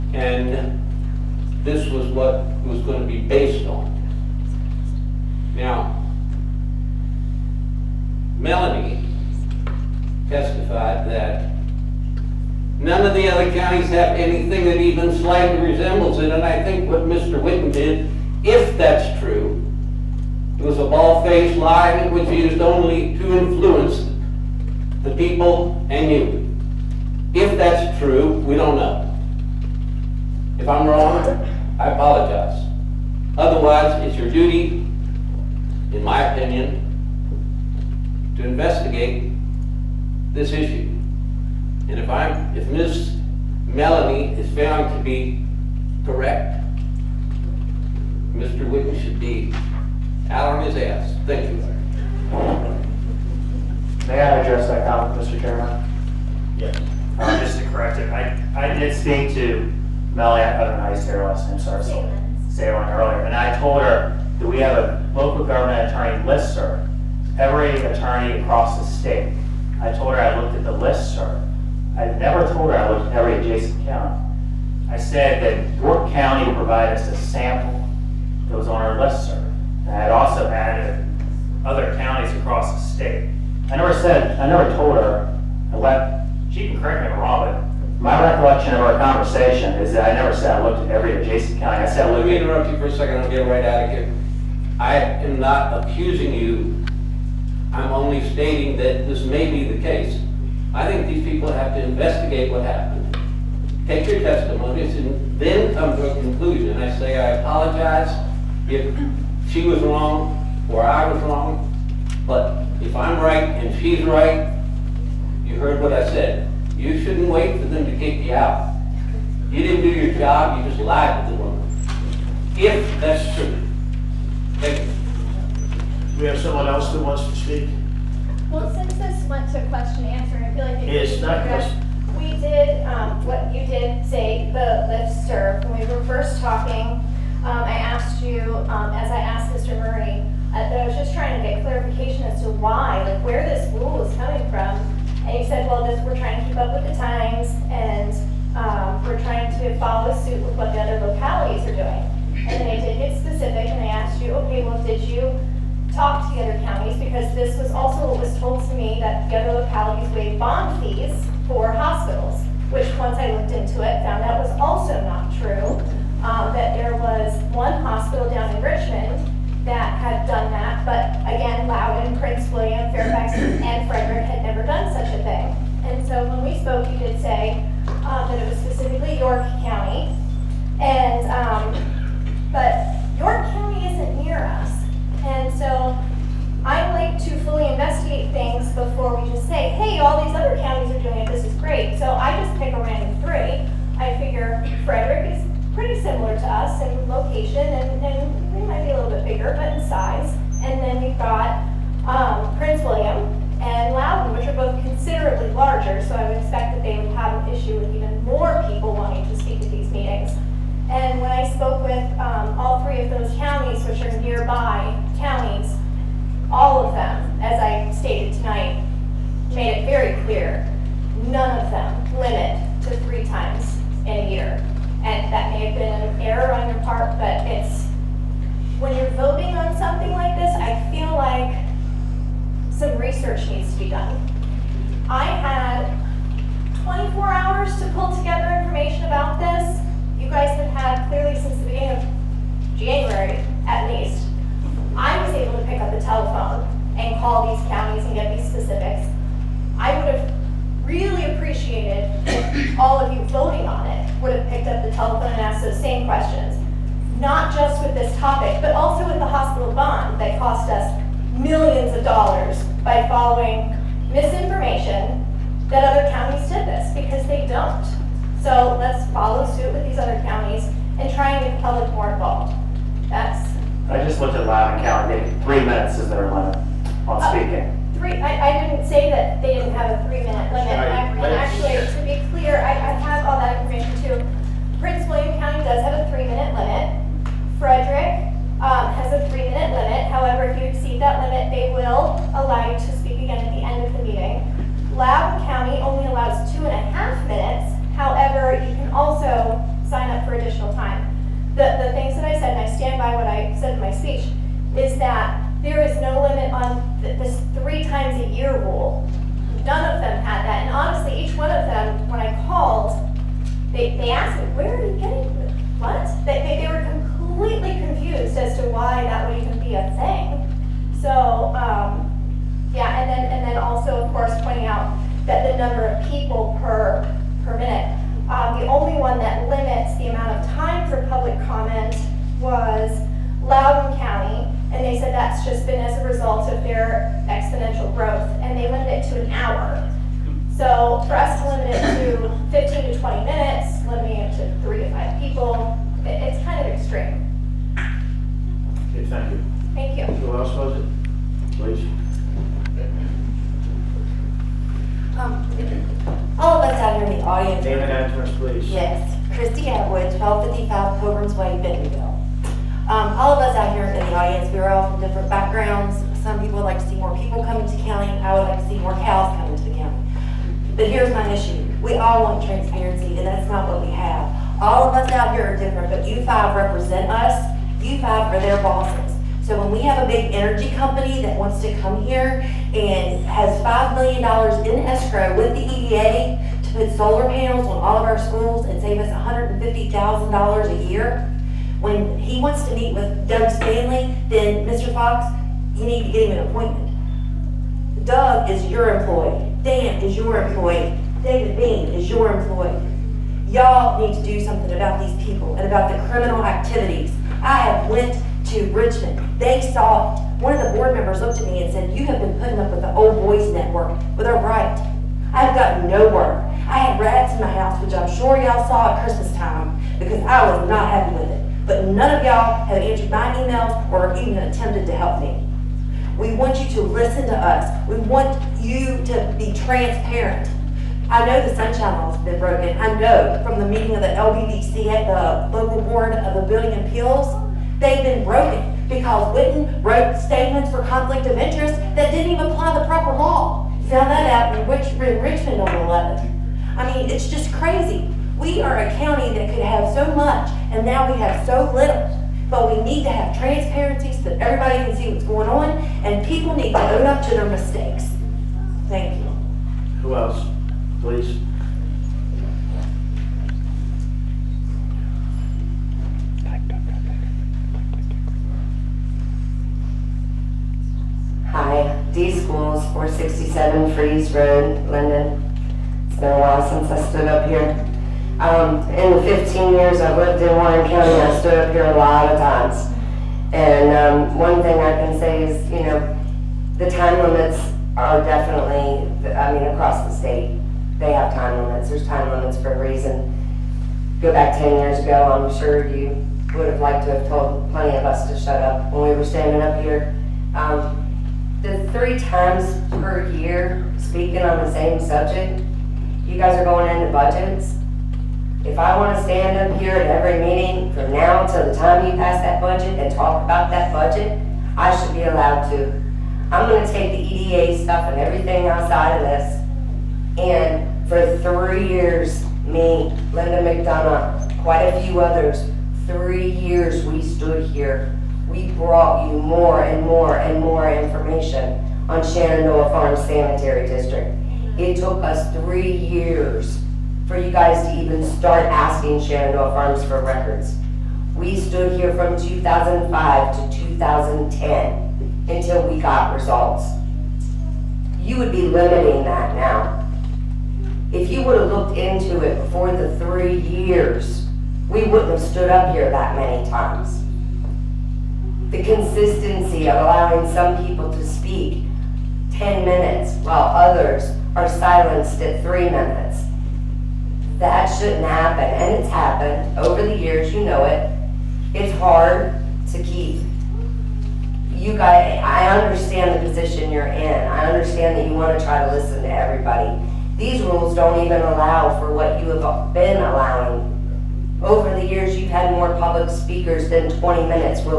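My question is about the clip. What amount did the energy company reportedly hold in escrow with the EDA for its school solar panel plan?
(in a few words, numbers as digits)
$5 million.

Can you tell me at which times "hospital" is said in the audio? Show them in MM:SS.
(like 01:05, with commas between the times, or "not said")
02:41, 02:47, 04:19.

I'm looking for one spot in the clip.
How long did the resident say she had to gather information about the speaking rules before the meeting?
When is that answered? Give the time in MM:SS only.
03:55.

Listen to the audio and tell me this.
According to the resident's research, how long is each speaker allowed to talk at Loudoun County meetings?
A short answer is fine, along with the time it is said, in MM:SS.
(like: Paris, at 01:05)
2.5 minutes, at 04:56.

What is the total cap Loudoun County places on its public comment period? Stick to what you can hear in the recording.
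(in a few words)
1 hour.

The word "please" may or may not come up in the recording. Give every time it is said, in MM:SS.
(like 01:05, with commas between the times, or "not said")
05:51, 05:58, 07:41.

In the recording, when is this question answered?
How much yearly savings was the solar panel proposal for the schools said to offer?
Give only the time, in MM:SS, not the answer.
06:29.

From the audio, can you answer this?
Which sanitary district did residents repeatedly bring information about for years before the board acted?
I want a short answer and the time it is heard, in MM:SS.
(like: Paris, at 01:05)
Shenandoah Farm Sanitary District, at 08:52.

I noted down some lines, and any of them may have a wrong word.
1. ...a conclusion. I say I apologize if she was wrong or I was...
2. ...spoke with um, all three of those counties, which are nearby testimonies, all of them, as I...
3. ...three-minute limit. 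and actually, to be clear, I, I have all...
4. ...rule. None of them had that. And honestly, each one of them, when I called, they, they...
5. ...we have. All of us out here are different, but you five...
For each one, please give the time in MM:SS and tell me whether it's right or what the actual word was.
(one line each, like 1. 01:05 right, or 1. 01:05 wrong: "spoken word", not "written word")
1. 01:46 right
2. 03:31 wrong: "counties", not "testimonies"
3. 04:40 right
4. 05:08 right
5. 06:13 right.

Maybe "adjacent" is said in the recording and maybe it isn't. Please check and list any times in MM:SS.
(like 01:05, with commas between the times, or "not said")
01:13, 01:31.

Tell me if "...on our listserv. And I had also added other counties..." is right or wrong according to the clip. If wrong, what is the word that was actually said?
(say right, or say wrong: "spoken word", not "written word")
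right.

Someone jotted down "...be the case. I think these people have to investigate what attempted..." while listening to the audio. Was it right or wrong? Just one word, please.
wrong.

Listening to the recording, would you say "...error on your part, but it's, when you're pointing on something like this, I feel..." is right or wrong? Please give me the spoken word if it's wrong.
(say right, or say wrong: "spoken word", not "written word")
wrong: "voting", not "pointing".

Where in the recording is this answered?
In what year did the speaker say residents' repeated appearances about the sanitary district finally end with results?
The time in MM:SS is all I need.
09:03.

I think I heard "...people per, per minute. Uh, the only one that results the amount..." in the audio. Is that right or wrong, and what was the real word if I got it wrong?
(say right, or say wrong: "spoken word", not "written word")
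wrong: "limits", not "results".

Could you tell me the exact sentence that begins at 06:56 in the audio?
I had rats in my house, which I'm sure y'all saw at Christmas time, because I was not happy with it.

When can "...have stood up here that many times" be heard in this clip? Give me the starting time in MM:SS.
09:15.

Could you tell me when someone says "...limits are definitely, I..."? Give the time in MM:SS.
08:07.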